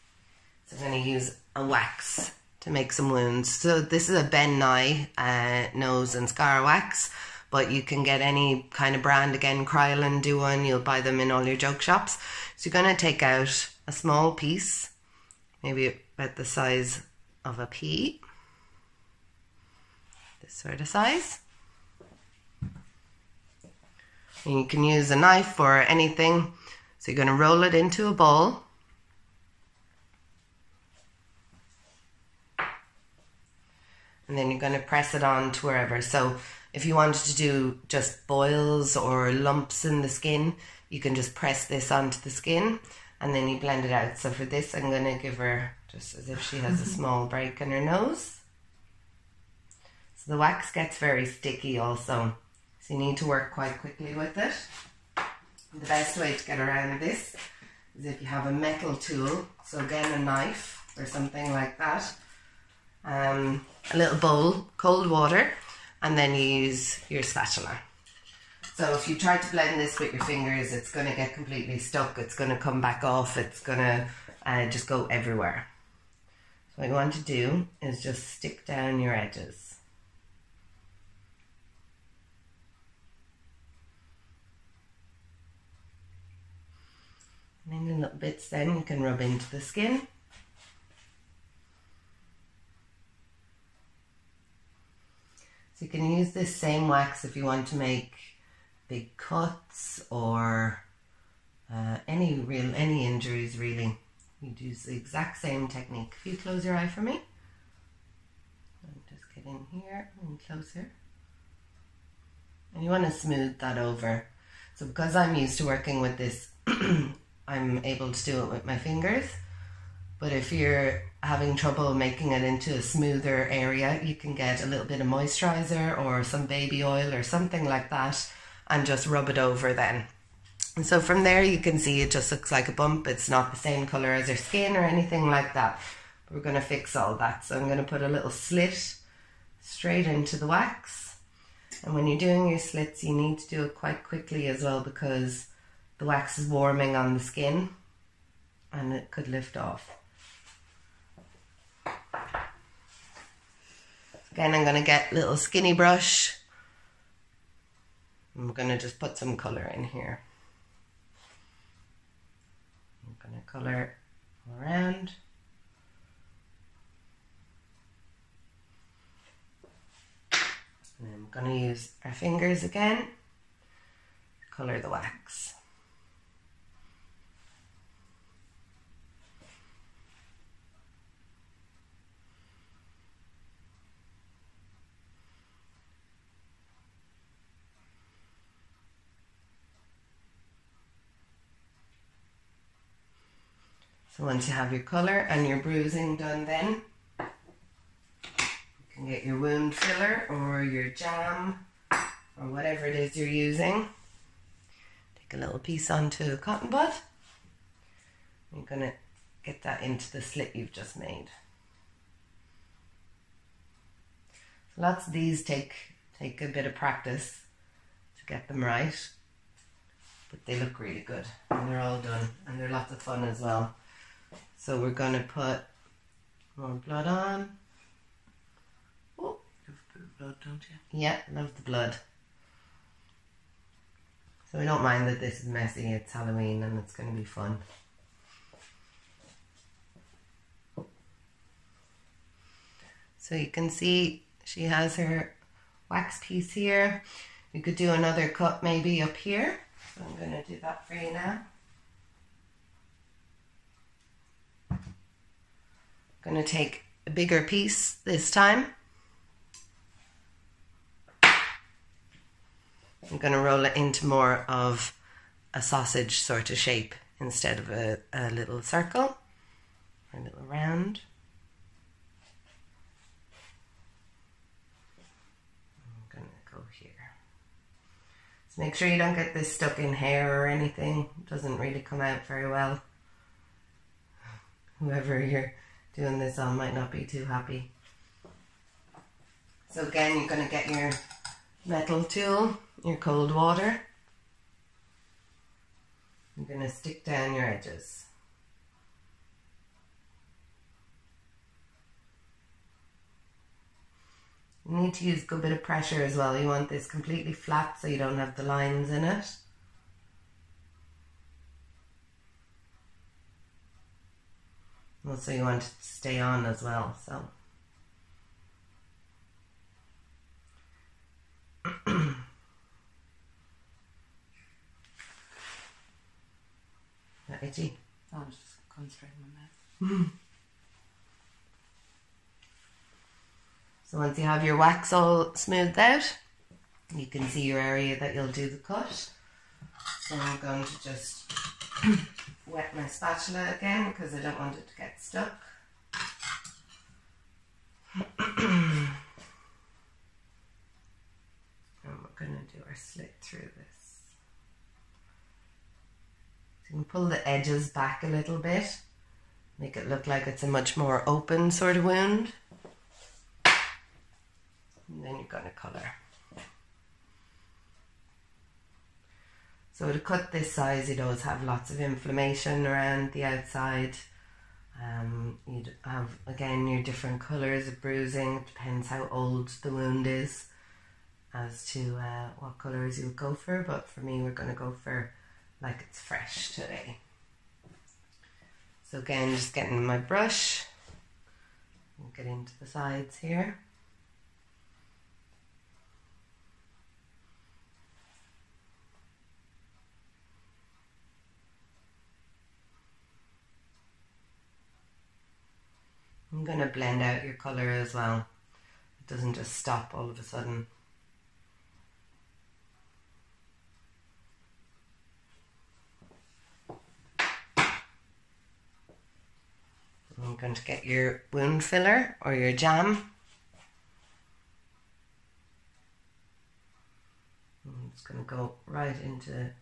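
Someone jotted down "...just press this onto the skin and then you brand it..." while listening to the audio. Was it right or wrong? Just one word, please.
wrong.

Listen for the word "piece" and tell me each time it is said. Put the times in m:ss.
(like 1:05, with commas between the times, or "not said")
0:14, 3:25, 4:06, 4:17.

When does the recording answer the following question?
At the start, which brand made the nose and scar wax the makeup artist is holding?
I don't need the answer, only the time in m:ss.
0:04.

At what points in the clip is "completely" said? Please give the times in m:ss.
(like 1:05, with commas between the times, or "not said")
1:11, 5:06.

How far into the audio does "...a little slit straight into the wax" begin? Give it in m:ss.
2:18.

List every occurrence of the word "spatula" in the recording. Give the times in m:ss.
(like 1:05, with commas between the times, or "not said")
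1:07, 5:42.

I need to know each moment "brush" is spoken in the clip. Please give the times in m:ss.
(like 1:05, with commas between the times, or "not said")
2:35, 6:29.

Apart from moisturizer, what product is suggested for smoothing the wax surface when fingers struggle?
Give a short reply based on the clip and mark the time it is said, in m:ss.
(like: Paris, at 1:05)
baby oil, at 2:06.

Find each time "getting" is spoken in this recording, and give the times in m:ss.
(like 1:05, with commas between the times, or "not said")
6:29.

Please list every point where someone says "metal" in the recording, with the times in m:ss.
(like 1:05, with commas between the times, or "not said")
0:58, 4:51.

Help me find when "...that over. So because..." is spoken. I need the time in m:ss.
1:53.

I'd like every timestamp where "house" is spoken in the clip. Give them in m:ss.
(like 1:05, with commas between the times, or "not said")
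not said.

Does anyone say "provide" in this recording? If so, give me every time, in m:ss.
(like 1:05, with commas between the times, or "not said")
not said.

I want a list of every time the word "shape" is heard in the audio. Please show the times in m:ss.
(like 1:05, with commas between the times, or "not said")
4:26.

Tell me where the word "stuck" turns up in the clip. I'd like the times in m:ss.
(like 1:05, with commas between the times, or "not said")
1:11, 4:39, 5:45.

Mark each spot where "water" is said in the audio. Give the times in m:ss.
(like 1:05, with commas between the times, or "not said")
1:05, 4:53.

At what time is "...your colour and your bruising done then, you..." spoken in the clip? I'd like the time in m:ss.
3:14.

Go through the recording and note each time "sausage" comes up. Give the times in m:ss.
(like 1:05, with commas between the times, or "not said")
4:25.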